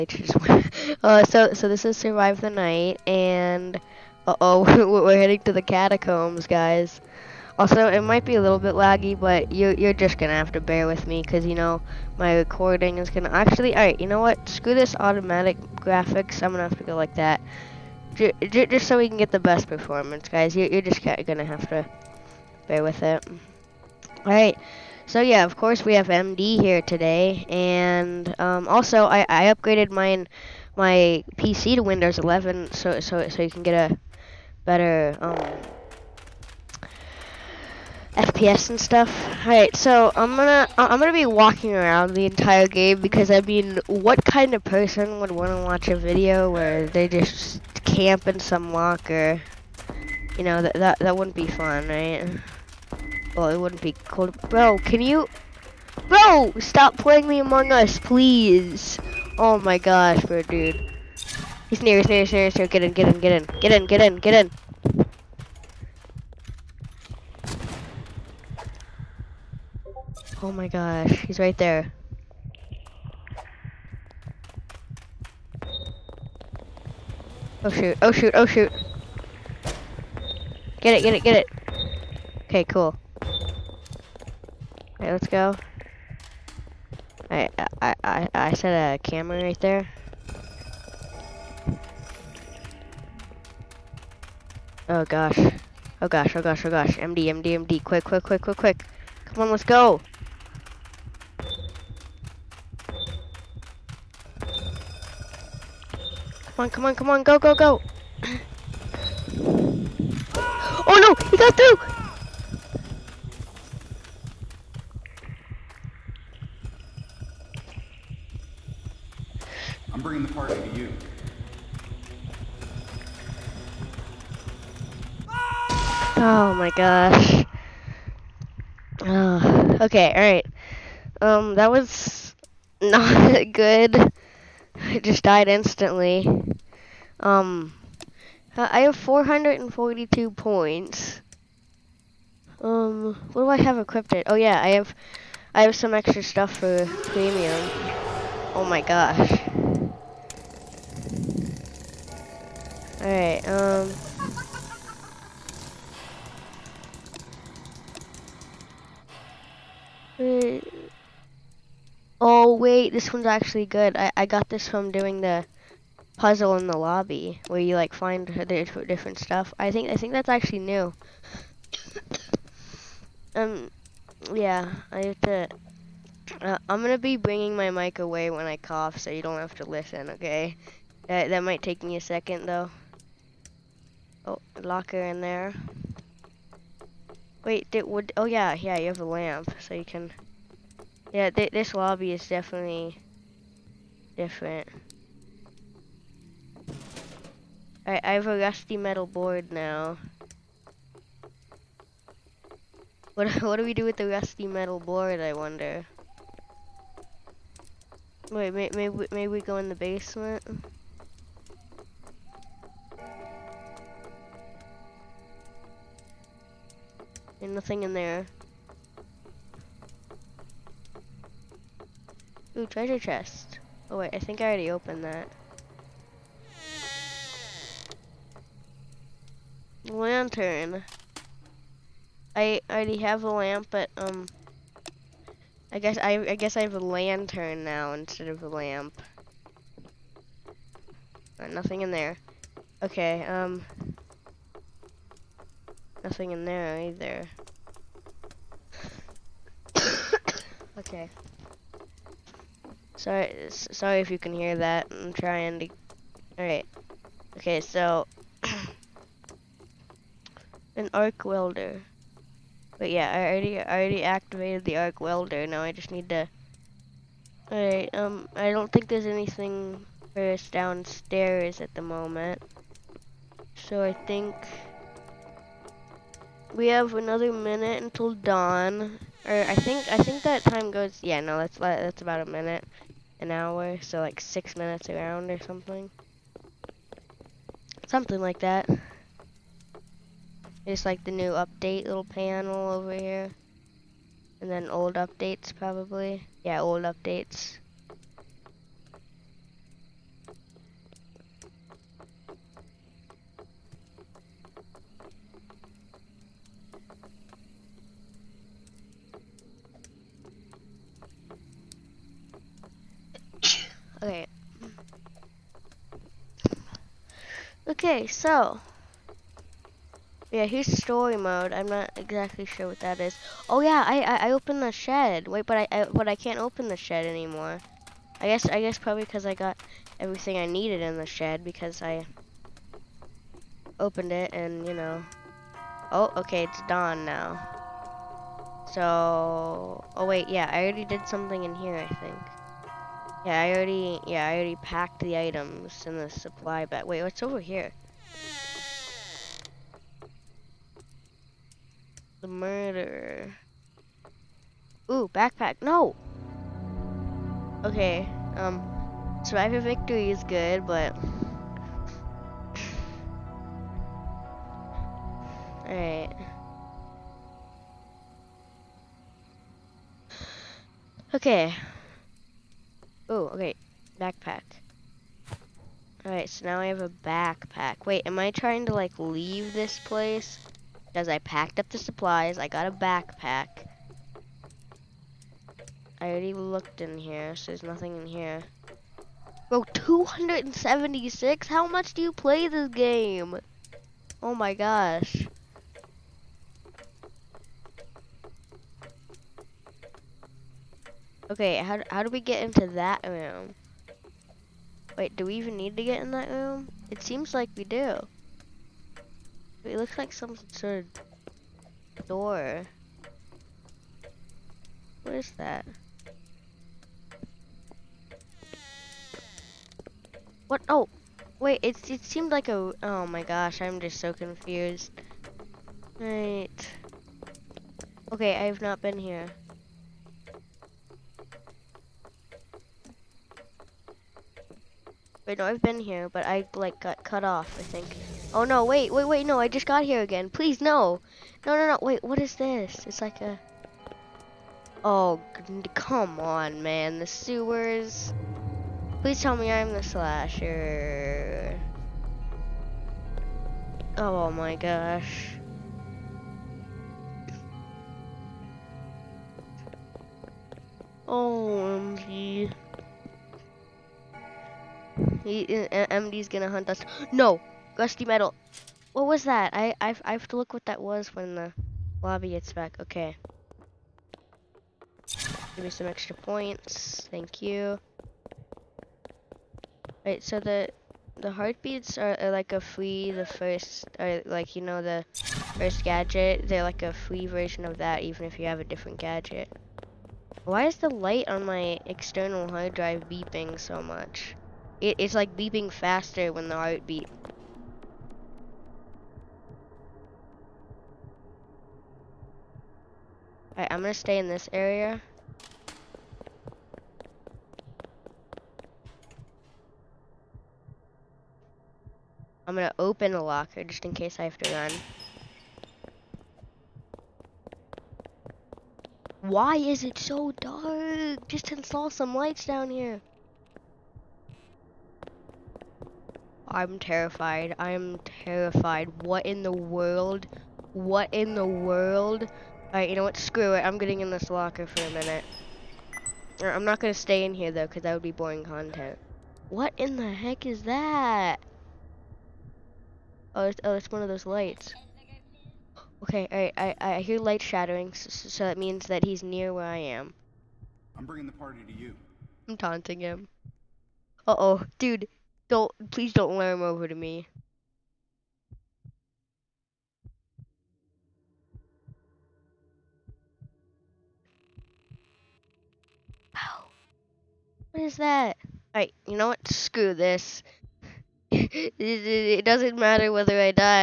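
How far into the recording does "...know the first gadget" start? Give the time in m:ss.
8:04.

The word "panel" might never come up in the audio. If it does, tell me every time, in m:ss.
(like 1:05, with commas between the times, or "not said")
4:52.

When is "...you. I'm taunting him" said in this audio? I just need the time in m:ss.
9:11.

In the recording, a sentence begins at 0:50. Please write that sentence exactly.
You know that that that wouldn't be fun, right?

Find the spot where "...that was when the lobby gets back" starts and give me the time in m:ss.
7:50.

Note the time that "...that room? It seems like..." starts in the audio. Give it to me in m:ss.
6:46.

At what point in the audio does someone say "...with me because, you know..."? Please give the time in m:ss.
0:10.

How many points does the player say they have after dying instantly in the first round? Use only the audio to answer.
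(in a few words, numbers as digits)
442.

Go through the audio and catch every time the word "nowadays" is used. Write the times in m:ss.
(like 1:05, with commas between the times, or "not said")
not said.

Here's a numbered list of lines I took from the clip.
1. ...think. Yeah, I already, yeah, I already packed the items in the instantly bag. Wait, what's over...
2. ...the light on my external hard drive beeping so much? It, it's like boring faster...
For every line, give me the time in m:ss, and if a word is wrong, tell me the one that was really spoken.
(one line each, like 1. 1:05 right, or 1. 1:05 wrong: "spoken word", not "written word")
1. 5:41 wrong: "supply", not "instantly"
2. 8:10 wrong: "beeping", not "boring".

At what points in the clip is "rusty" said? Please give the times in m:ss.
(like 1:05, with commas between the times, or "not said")
3:18, 3:24, 7:47.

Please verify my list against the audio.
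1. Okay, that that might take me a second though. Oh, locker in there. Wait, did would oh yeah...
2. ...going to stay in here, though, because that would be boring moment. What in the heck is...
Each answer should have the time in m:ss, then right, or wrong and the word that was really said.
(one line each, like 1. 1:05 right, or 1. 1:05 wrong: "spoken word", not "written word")
1. 3:00 right
2. 8:56 wrong: "content", not "moment".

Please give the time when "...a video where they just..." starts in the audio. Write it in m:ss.
0:45.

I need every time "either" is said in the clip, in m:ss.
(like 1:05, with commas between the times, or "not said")
4:06.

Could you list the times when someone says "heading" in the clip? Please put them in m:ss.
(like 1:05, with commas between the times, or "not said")
0:05.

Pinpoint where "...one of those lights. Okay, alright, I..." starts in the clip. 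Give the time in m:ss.
9:03.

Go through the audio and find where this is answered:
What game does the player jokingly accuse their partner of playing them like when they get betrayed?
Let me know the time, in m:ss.
0:57.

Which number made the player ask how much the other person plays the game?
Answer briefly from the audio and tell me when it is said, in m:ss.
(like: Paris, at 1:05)
276, at 6:29.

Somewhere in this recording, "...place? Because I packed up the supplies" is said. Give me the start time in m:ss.
6:19.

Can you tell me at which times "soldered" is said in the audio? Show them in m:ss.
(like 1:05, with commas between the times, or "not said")
not said.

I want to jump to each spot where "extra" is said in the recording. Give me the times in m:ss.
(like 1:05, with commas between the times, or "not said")
2:25, 7:55.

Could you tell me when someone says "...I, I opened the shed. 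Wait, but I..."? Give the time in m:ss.
5:24.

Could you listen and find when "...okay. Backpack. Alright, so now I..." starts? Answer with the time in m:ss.
6:13.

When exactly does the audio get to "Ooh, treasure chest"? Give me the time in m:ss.
3:42.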